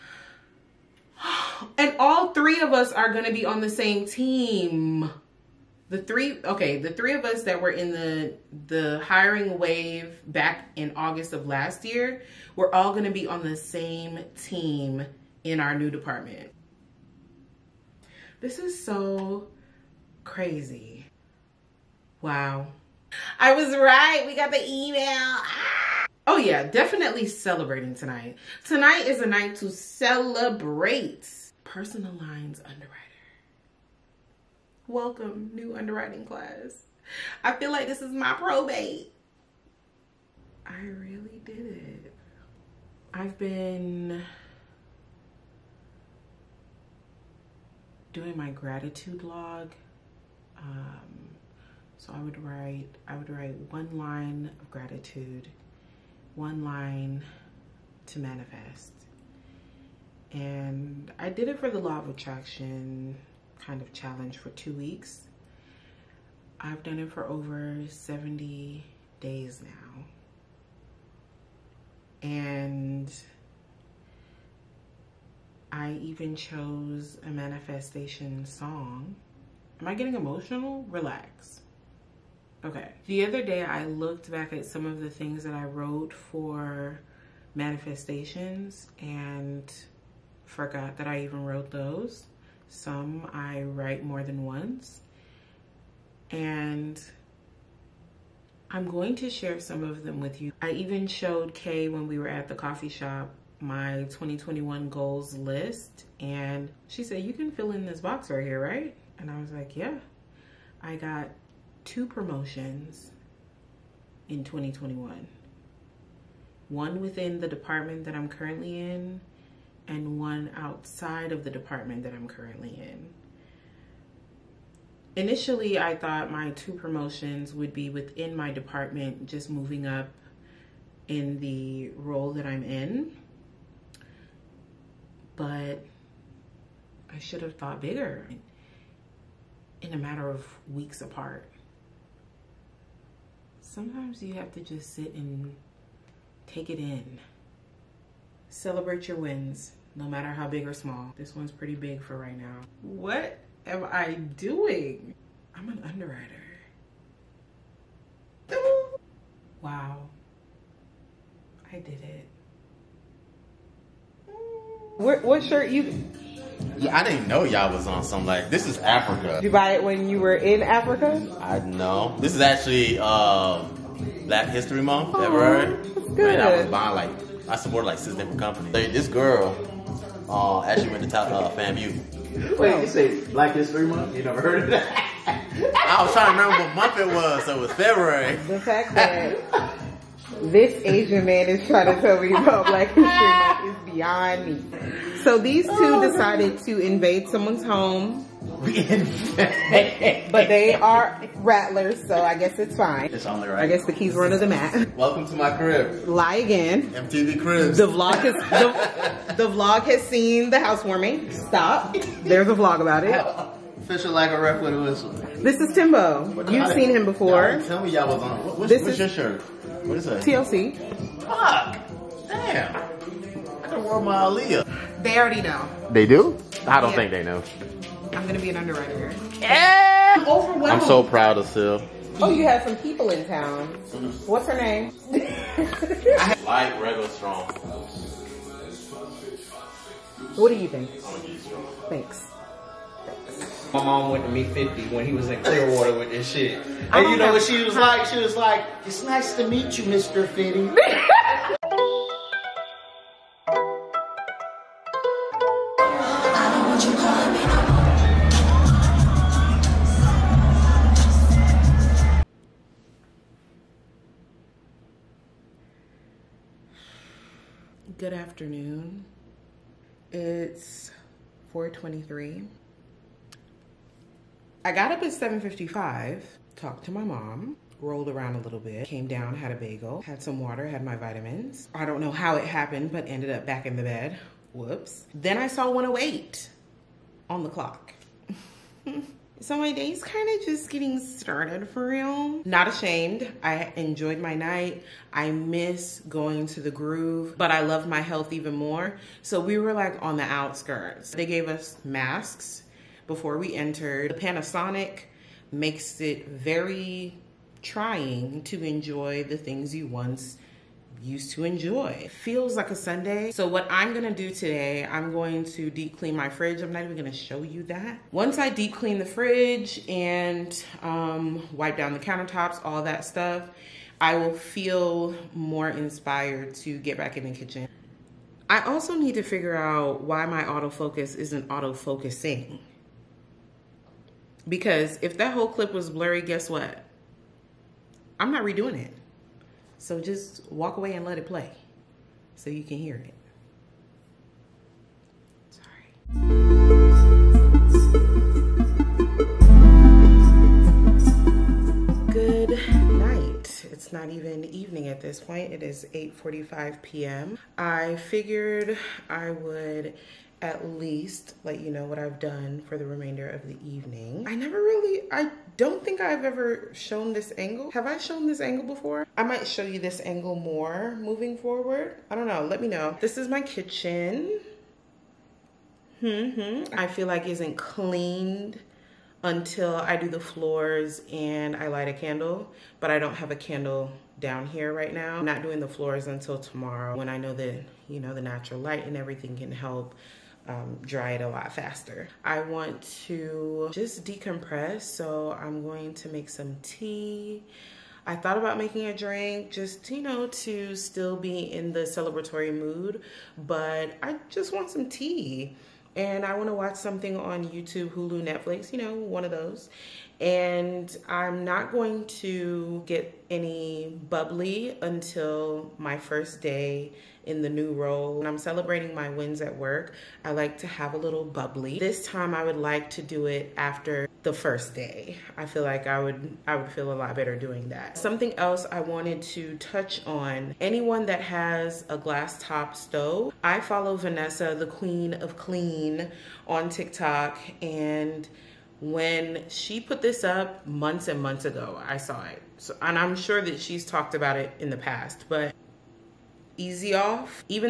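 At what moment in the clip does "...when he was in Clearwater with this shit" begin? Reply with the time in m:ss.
4:04.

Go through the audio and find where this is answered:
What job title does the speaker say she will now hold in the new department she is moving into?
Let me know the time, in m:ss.
0:31.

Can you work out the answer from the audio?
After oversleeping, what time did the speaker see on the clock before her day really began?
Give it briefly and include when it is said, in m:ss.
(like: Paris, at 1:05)
1:08, at 4:45.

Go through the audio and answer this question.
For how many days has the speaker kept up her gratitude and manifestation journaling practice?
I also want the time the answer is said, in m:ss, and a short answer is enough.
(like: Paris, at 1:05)
Over 70 days, at 1:07.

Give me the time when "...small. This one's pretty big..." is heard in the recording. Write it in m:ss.
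2:30.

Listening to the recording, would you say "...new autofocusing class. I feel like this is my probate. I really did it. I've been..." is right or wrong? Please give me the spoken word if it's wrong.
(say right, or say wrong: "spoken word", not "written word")
wrong: "underwriting", not "autofocusing".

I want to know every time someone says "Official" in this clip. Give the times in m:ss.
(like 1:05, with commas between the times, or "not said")
3:33.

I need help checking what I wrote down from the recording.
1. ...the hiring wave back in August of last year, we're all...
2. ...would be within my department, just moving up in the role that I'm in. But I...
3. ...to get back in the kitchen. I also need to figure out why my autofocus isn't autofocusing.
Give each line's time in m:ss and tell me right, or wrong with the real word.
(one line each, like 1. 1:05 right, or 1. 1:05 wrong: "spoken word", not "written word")
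1. 0:08 right
2. 2:07 right
3. 5:26 right.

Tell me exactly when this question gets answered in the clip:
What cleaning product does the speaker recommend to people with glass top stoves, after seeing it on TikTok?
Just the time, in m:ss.
7:26.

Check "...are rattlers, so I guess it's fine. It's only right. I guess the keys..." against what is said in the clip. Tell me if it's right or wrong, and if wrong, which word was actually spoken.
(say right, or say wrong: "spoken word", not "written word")
right.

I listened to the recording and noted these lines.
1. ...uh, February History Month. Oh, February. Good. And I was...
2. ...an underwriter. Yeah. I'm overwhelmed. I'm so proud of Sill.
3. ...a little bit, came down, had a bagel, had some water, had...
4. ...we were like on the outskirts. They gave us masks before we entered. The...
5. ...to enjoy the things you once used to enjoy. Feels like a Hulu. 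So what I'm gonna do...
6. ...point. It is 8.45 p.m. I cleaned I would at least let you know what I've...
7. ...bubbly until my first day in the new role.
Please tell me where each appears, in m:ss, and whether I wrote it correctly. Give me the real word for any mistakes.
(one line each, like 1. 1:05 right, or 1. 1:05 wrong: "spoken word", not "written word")
1. 2:53 wrong: "Black", not "February"
2. 3:48 right
3. 4:38 right
4. 4:59 right
5. 5:08 wrong: "Sunday", not "Hulu"
6. 5:55 wrong: "figured", not "cleaned"
7. 6:54 right.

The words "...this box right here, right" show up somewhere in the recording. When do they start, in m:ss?
1:47.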